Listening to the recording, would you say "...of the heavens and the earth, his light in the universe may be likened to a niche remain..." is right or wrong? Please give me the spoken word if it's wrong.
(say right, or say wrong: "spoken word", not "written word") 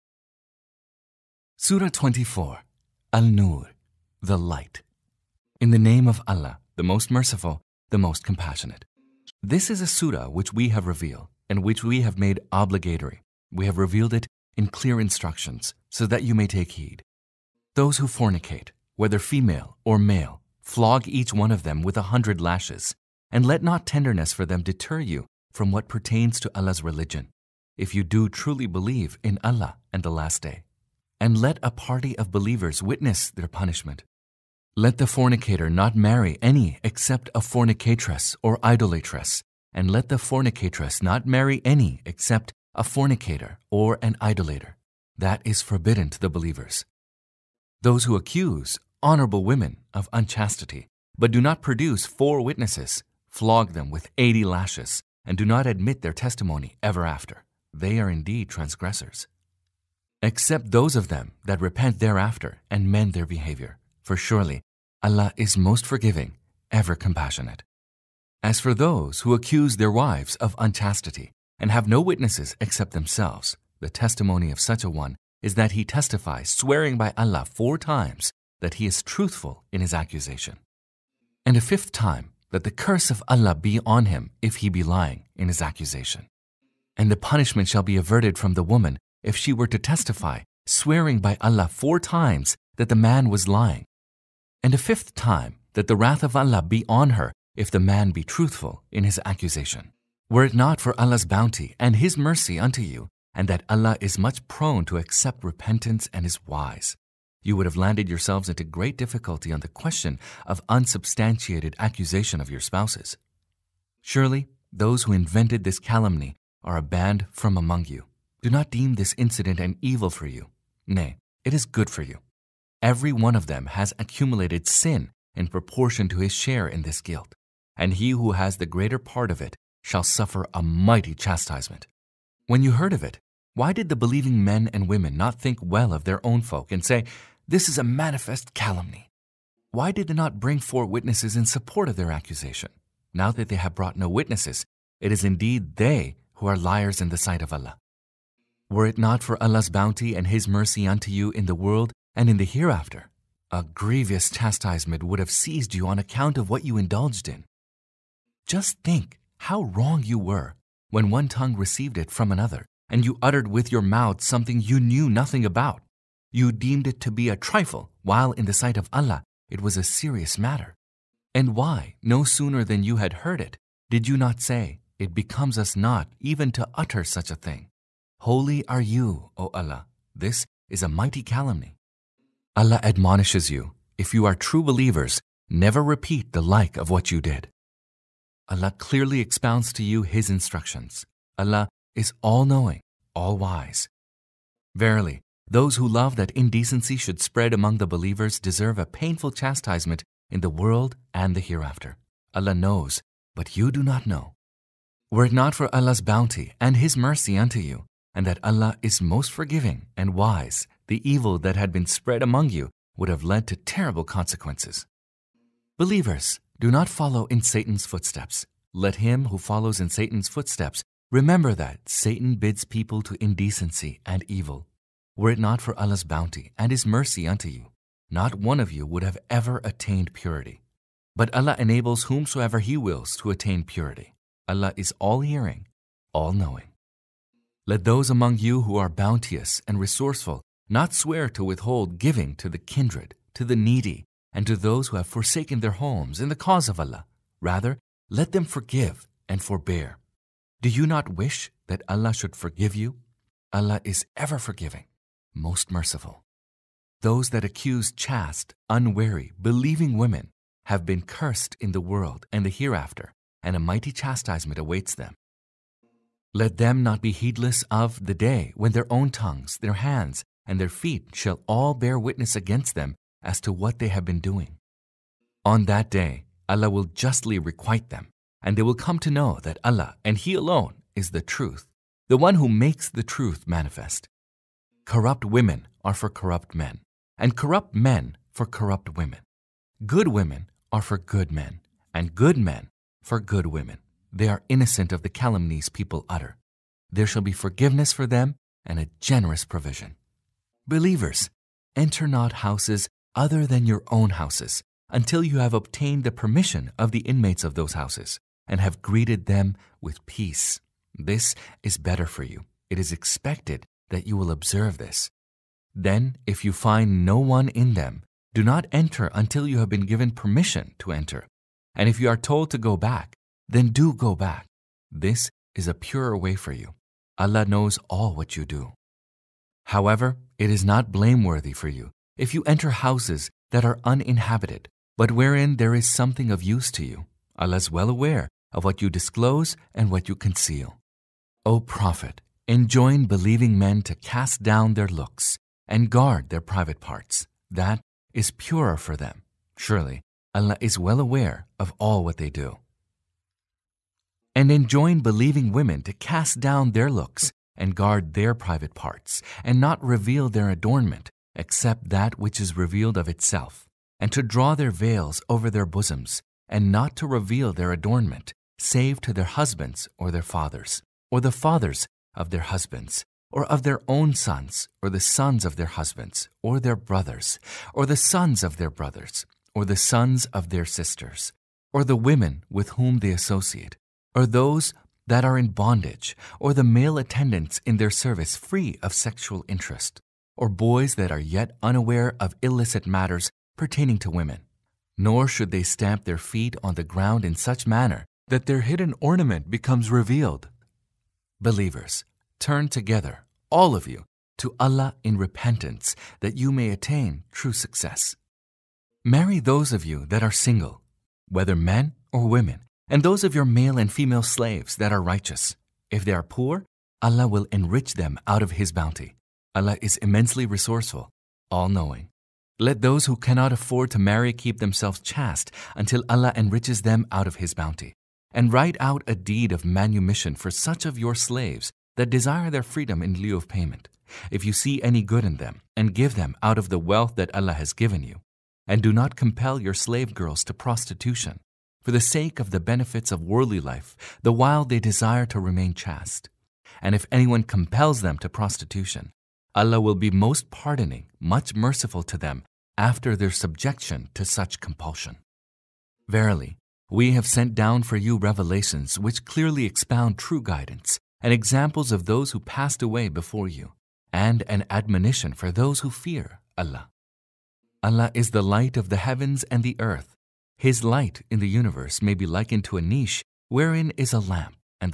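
wrong: "wherein", not "remain".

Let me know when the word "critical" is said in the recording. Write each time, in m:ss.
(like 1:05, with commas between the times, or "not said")
not said.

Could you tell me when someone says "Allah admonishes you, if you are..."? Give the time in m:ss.
3:02.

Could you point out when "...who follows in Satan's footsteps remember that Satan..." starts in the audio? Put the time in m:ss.
3:39.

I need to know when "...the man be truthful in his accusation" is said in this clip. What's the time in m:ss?
1:37.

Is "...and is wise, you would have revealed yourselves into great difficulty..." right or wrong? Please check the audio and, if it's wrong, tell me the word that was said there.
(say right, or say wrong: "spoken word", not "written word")
wrong: "landed", not "revealed".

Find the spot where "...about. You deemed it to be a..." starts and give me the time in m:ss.
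2:45.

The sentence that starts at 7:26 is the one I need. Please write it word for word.
And if anyone compels them to prostitution, Allah will be most pardoning, much merciful to them after their subjection to such compulsion.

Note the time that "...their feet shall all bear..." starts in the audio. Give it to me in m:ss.
4:30.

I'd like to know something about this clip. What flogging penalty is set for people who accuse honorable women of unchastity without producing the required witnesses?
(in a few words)
80 lashes.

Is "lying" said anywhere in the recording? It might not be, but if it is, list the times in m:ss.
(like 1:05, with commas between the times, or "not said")
1:24, 1:33.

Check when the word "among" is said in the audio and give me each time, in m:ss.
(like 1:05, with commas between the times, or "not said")
1:57, 3:17, 3:32, 3:58.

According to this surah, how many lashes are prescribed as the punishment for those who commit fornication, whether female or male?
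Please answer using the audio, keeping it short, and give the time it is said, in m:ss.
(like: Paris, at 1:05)
100, at 0:21.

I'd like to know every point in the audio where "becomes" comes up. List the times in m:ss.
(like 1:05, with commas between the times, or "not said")
2:55, 6:39.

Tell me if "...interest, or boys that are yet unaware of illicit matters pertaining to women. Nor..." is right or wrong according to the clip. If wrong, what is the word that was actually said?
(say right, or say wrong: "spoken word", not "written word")
right.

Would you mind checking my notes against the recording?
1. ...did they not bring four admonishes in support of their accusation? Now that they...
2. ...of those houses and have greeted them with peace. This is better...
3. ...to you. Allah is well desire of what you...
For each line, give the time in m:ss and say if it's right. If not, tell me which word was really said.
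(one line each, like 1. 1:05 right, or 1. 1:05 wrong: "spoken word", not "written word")
1. 2:19 wrong: "witnesses", not "admonishes"
2. 5:07 right
3. 5:36 wrong: "aware", not "desire".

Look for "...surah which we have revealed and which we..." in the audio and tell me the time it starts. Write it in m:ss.
0:09.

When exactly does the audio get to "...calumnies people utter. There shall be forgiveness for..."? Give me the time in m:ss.
4:55.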